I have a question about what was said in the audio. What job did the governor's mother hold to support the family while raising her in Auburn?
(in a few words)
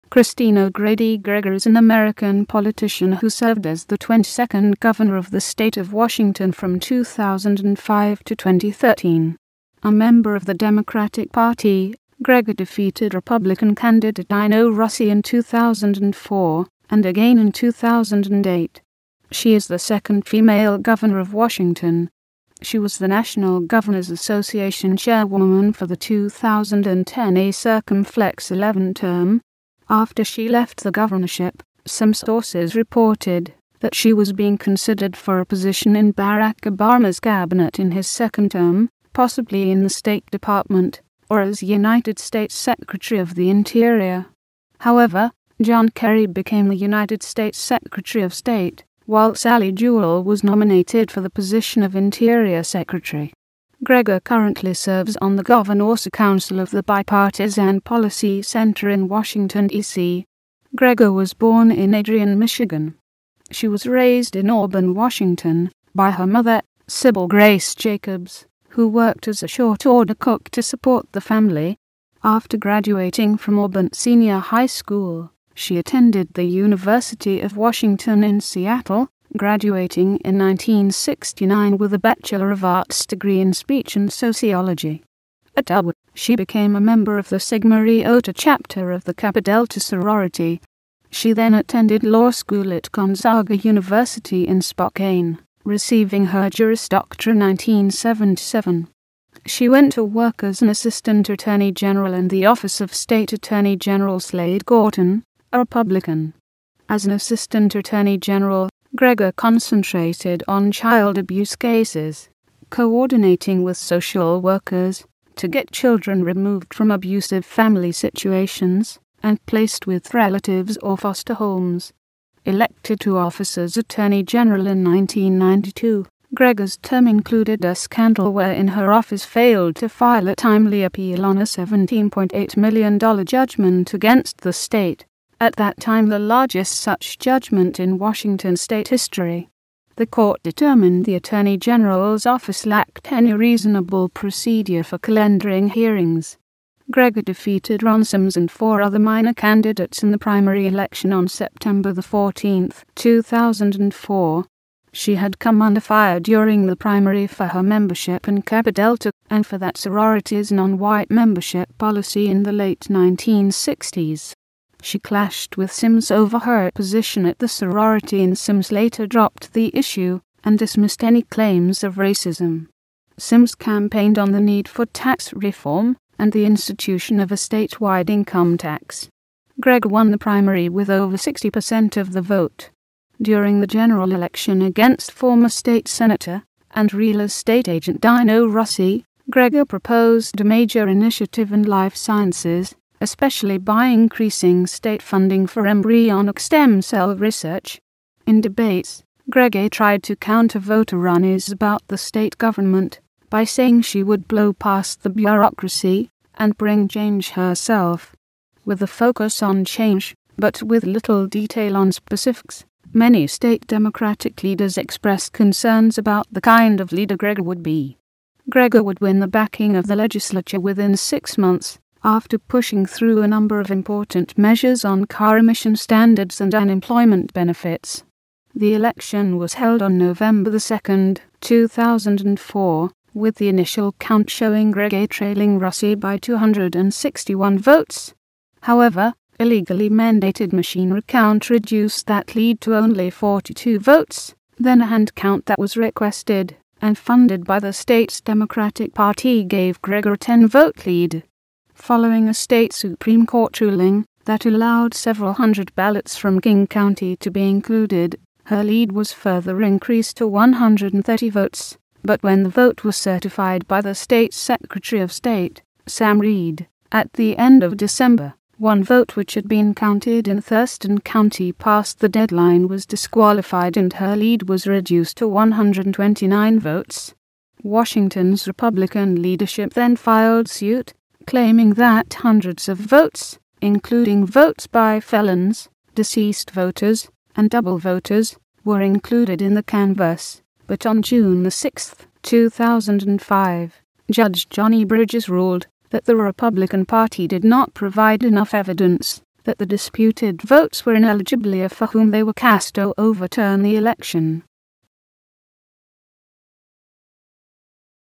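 short order cook.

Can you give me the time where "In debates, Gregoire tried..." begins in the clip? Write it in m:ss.
3:18.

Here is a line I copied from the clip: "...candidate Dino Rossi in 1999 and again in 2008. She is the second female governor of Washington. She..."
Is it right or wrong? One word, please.
wrong.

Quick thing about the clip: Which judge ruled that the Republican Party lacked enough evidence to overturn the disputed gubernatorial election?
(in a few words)
Johnny Bridges.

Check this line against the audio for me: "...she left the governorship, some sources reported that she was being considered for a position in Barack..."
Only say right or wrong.
right.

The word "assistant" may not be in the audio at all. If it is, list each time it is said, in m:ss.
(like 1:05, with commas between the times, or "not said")
1:40, 1:47.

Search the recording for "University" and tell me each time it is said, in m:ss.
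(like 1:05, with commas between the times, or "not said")
1:16, 1:33.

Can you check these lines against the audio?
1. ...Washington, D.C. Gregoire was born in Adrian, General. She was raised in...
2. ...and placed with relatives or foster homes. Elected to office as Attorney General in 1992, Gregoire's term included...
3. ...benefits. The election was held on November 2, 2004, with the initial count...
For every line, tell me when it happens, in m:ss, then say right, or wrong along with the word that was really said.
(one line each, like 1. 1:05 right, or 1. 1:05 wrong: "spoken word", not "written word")
1. 0:59 wrong: "Michigan", not "General"
2. 1:59 right
3. 3:47 right.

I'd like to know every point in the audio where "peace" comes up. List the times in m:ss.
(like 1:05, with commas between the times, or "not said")
not said.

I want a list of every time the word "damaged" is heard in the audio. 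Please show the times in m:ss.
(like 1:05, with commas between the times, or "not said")
not said.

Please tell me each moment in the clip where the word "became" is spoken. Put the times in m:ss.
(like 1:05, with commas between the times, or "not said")
0:46, 1:26.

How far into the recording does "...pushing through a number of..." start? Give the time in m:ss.
3:42.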